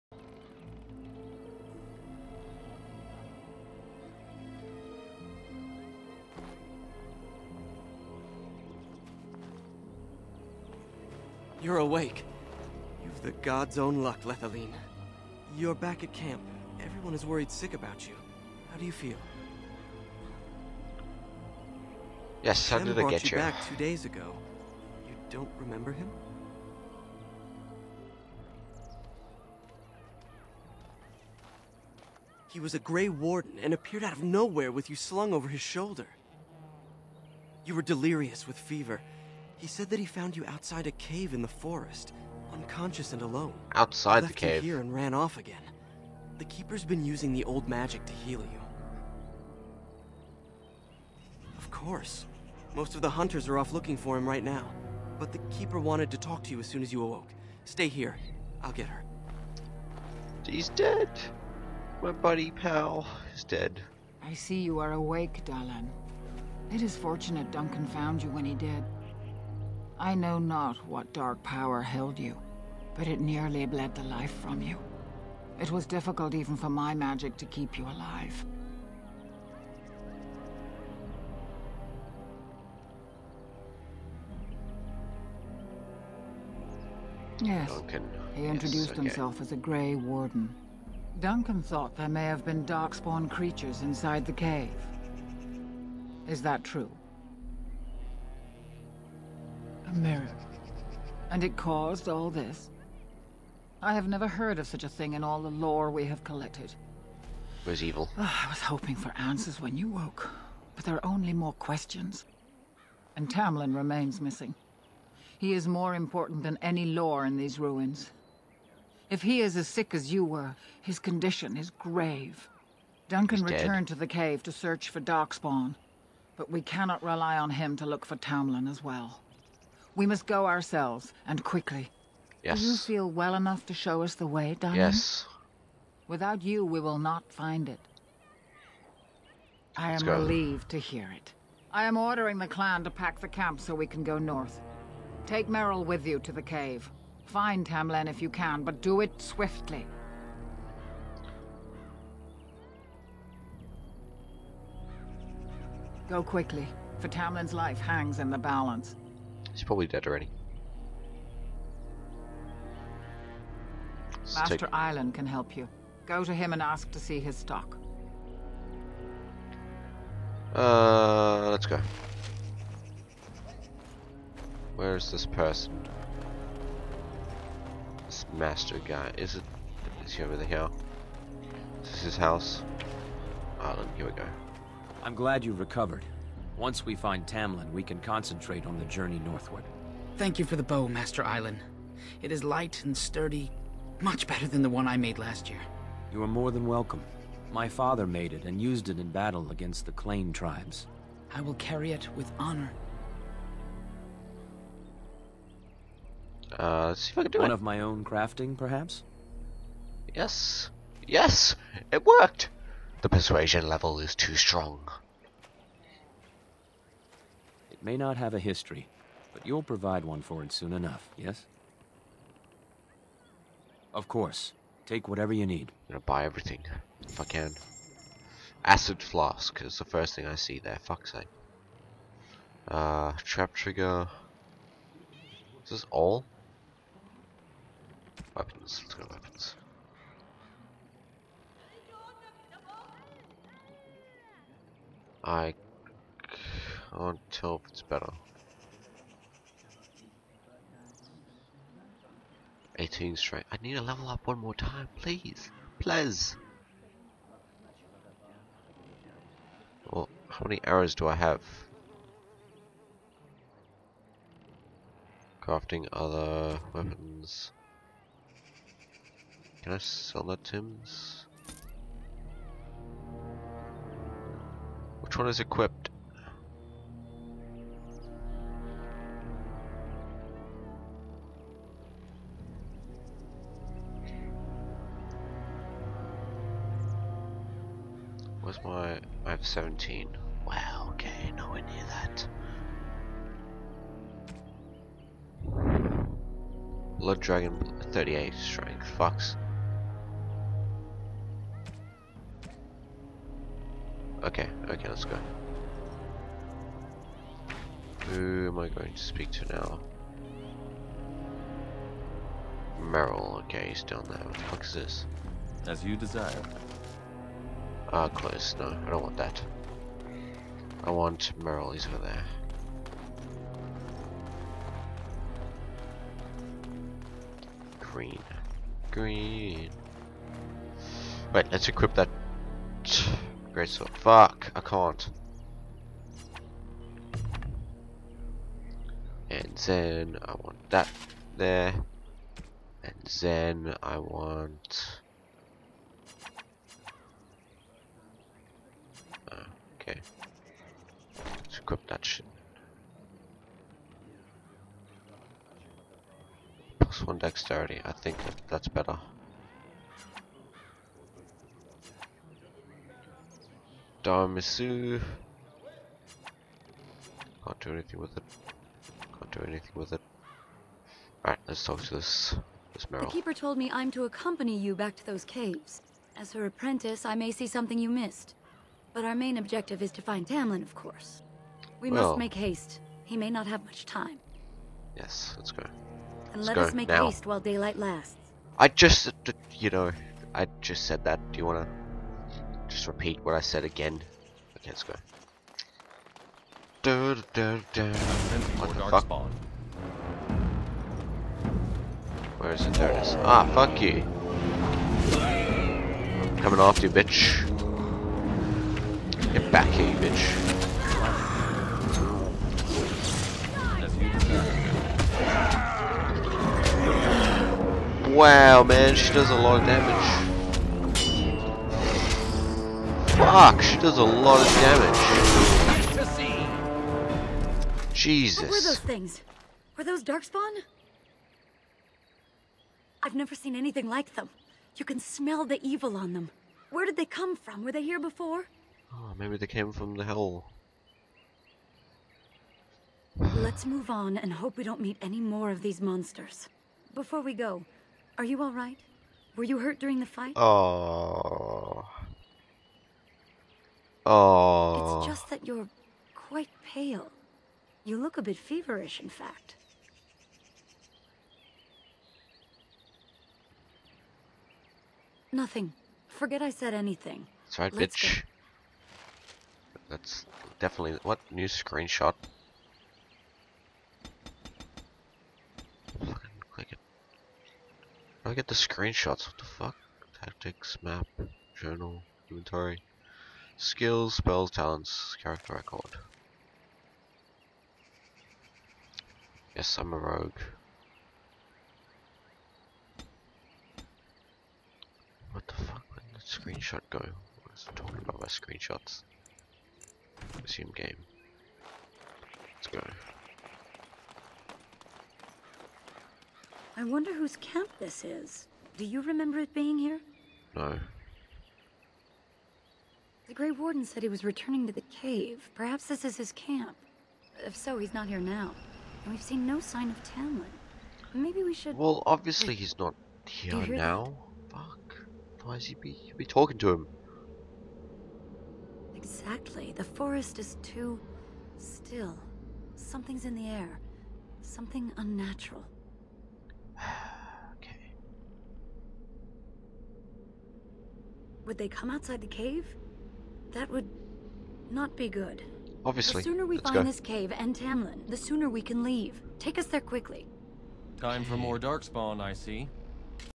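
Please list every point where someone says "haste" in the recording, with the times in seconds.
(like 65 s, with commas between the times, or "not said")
382 s, 387 s.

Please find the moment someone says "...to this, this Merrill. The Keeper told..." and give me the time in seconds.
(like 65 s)
371 s.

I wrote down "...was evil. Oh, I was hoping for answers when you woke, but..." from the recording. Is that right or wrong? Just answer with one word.
right.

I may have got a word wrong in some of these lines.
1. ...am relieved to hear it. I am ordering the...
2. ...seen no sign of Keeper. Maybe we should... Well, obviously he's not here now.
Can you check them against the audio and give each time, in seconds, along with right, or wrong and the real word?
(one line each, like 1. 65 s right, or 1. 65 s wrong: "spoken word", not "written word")
1. 139 s right
2. 519 s wrong: "Tamlen", not "Keeper".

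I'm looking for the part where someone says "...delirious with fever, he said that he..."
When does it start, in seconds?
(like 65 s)
37 s.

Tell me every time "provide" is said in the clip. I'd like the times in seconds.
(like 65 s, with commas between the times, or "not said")
219 s.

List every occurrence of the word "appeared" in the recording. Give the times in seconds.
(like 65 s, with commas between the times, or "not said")
33 s.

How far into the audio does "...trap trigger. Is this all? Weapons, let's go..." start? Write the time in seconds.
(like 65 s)
233 s.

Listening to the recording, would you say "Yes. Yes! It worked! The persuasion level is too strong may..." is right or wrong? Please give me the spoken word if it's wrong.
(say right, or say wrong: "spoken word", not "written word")
right.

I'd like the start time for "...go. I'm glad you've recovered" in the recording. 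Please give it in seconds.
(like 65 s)
184 s.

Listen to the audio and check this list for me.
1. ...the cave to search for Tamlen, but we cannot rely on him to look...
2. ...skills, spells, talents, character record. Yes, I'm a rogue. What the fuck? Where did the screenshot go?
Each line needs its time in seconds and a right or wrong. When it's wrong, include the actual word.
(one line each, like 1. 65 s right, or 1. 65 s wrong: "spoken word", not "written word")
1. 123 s wrong: "Darkspawn", not "Tamlen"
2. 483 s right.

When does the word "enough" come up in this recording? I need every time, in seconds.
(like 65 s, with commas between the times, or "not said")
133 s, 220 s.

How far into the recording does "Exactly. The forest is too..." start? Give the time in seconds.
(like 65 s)
528 s.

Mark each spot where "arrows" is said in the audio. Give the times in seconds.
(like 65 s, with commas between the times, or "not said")
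260 s.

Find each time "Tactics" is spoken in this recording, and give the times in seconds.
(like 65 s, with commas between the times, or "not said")
480 s.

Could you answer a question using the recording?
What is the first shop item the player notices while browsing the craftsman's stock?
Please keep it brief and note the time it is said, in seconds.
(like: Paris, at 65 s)
Acid flask, at 228 s.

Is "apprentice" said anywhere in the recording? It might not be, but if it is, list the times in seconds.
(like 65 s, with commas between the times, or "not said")
376 s.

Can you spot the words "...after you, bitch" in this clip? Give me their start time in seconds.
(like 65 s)
406 s.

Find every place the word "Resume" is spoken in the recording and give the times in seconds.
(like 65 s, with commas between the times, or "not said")
500 s.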